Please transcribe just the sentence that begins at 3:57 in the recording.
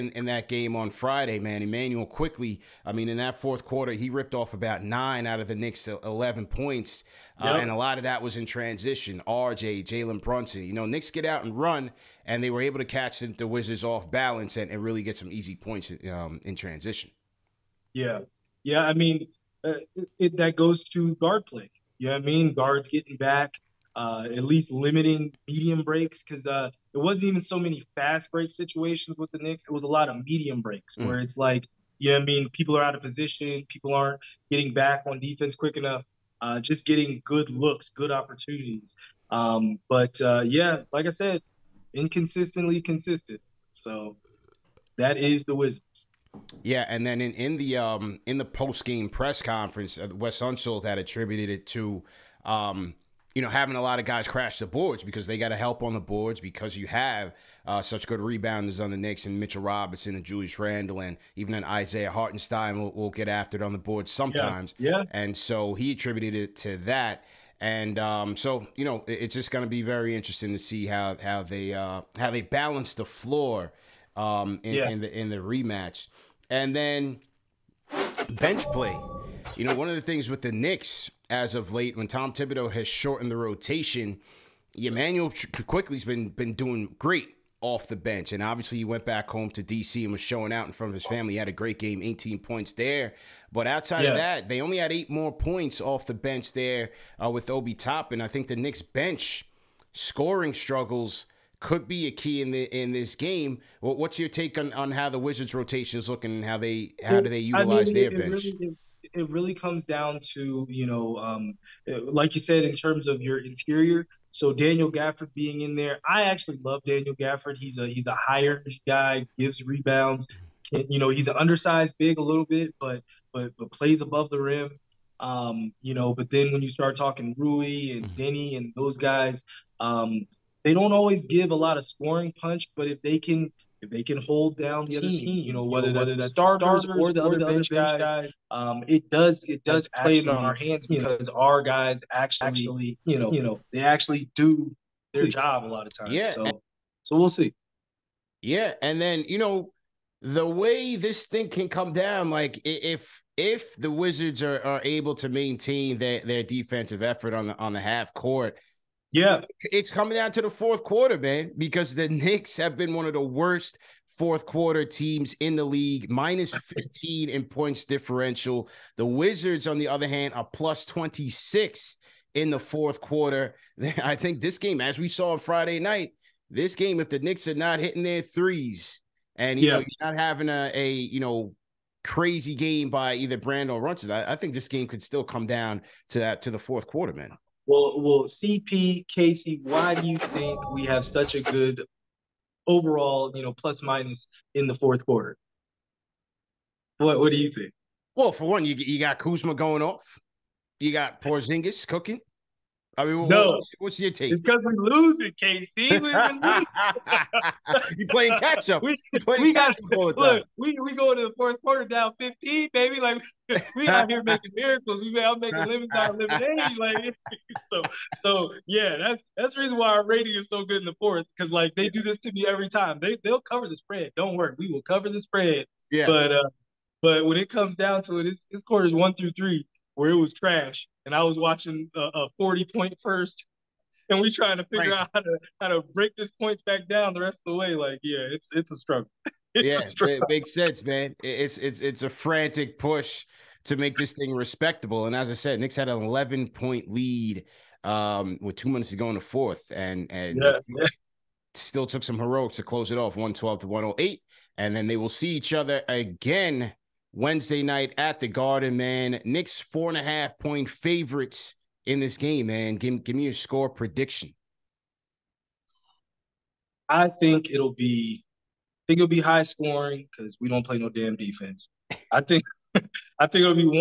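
Like, yeah, it's it's a struggle.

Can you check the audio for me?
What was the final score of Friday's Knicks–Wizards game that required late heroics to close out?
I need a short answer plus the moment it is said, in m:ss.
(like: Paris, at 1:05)
112-108, at 4:13.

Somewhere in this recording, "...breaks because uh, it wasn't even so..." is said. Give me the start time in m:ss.
0:25.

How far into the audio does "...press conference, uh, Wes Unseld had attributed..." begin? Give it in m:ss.
0:49.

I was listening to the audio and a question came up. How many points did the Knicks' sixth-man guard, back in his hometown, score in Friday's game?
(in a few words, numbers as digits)
18.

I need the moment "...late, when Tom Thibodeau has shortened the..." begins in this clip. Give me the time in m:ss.
1:21.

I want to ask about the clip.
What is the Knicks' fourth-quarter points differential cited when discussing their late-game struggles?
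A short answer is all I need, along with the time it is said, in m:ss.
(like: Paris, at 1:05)
-15, at 2:46.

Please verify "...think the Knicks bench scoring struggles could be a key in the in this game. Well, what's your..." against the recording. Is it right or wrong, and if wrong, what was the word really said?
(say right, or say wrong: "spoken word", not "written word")
right.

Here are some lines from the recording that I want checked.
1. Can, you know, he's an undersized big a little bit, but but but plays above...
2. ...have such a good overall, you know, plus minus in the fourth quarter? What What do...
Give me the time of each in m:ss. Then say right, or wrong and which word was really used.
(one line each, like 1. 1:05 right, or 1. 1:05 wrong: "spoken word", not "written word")
1. 2:00 right
2. 3:10 right.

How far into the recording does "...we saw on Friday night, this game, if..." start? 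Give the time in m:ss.
2:54.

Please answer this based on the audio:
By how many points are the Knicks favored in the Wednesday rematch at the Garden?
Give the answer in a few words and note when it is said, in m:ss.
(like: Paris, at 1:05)
4.5, at 4:19.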